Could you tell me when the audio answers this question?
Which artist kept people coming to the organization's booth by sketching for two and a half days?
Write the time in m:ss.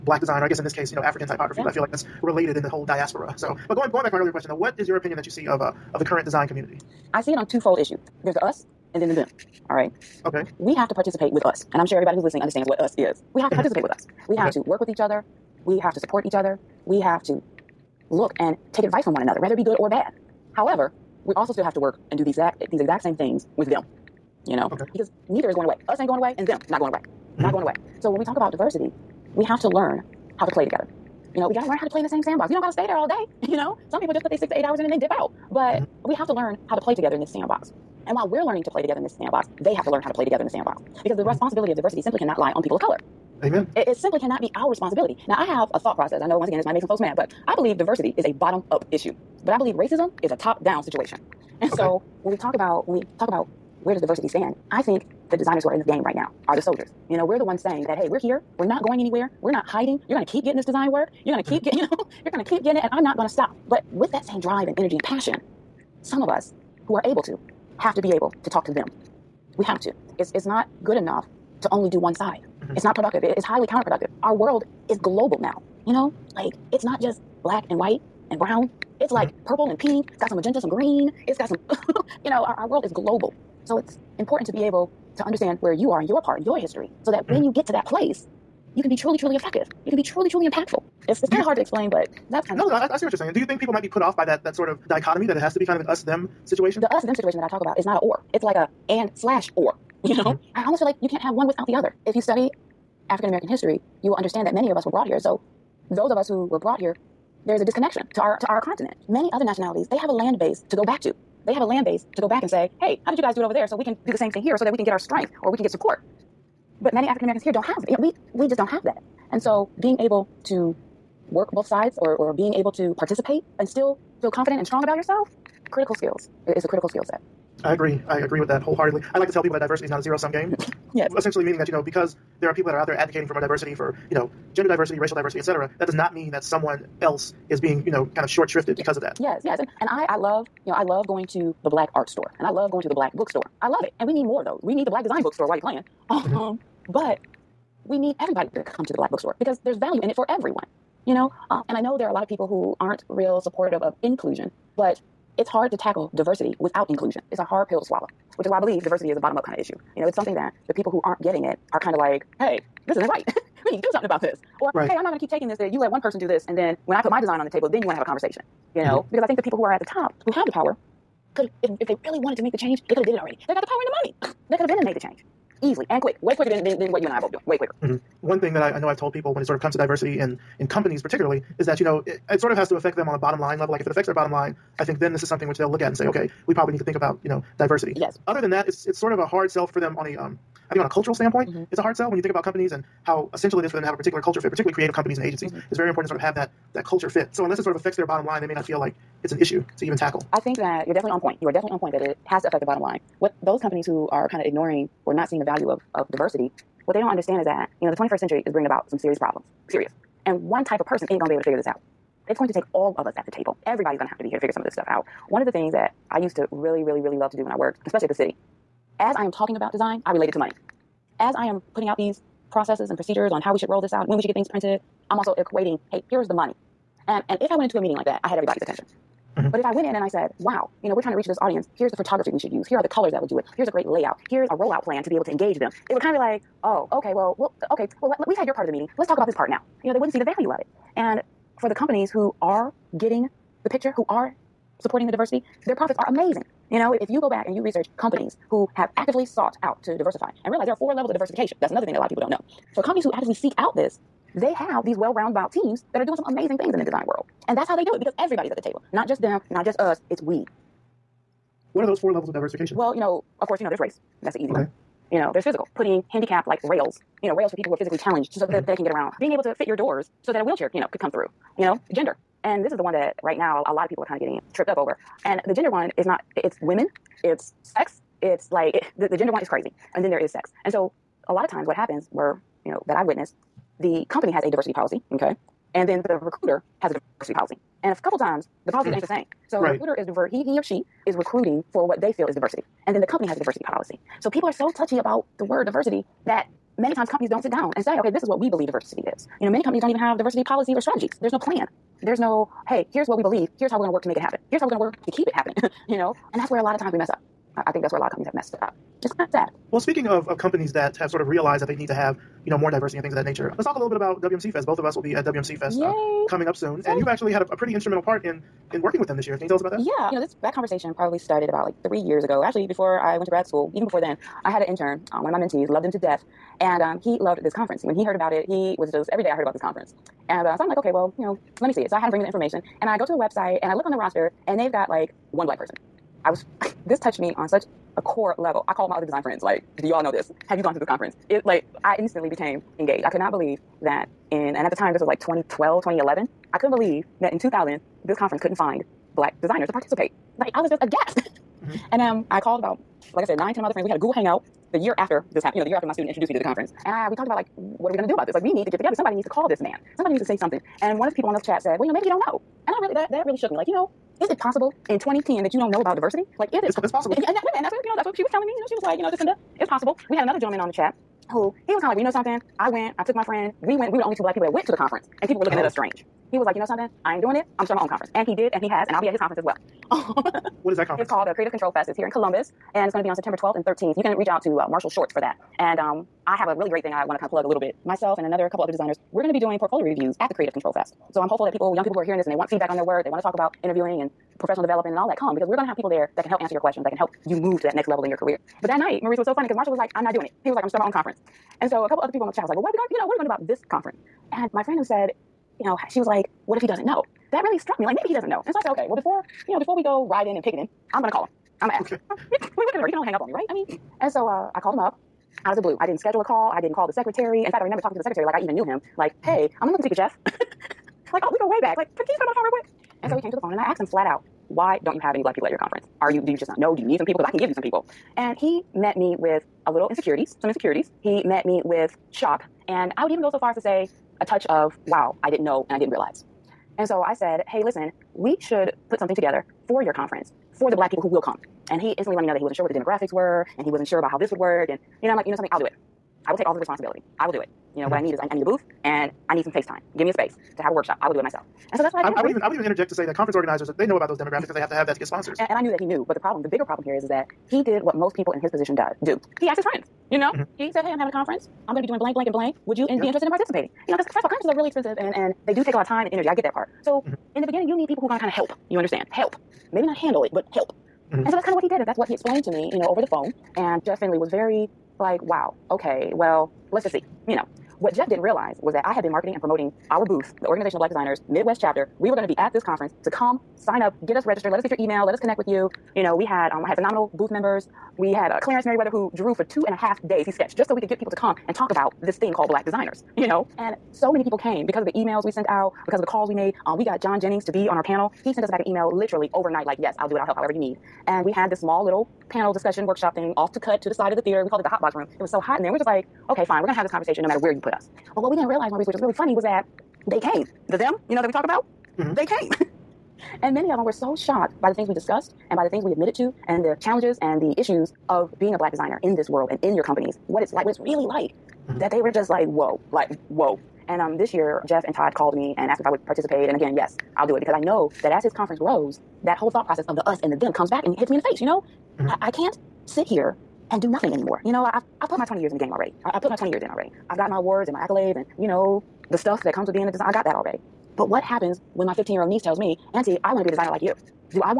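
8:08.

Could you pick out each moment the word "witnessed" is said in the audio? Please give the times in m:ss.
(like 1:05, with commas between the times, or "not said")
4:43.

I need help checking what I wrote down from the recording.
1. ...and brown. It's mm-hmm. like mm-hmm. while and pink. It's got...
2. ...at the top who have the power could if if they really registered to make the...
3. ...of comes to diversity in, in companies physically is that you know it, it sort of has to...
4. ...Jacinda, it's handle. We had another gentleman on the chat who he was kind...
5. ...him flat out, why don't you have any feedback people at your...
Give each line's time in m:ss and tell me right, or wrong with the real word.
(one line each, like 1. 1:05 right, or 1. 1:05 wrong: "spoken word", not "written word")
1. 1:18 wrong: "purple", not "while"
2. 2:49 wrong: "wanted", not "registered"
3. 2:59 wrong: "particularly", not "physically"
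4. 6:09 wrong: "possible", not "handle"
5. 7:03 wrong: "black", not "feedback".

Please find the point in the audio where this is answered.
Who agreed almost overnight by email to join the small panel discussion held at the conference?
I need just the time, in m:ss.
8:17.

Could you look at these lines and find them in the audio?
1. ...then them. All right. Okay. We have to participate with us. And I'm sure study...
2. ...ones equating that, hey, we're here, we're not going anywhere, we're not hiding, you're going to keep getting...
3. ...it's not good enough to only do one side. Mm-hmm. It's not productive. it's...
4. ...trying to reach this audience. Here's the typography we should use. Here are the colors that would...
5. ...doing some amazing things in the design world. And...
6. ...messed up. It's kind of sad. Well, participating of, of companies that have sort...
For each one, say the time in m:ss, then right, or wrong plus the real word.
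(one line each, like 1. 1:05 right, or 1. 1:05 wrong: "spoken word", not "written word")
1. 0:09 wrong: "everybody", not "study"
2. 0:57 wrong: "saying", not "equating"
3. 1:10 right
4. 3:51 wrong: "photography", not "typography"
5. 4:16 right
6. 5:08 wrong: "speaking", not "participating".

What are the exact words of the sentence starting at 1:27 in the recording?
when you get to that place, you can be truly, truly effective.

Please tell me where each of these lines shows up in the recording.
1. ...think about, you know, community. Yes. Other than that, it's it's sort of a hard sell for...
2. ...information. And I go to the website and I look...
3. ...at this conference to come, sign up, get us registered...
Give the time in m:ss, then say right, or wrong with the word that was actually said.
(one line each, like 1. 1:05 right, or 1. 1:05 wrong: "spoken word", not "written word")
1. 3:06 wrong: "diversity", not "community"
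2. 5:32 right
3. 8:02 right.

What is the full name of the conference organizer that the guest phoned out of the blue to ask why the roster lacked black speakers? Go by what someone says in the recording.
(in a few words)
Jeff Finley.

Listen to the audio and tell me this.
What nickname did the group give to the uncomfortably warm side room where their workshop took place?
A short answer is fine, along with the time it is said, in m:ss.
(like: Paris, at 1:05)
The hot box room, at 8:24.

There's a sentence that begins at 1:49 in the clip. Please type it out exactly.
Many other nationalities, they have a land base to go back to.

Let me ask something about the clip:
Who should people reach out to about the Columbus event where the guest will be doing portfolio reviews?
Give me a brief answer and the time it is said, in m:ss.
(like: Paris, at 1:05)
Marshall Shorts, at 6:24.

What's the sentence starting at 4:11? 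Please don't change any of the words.
That's another thing that a lot of people don't know.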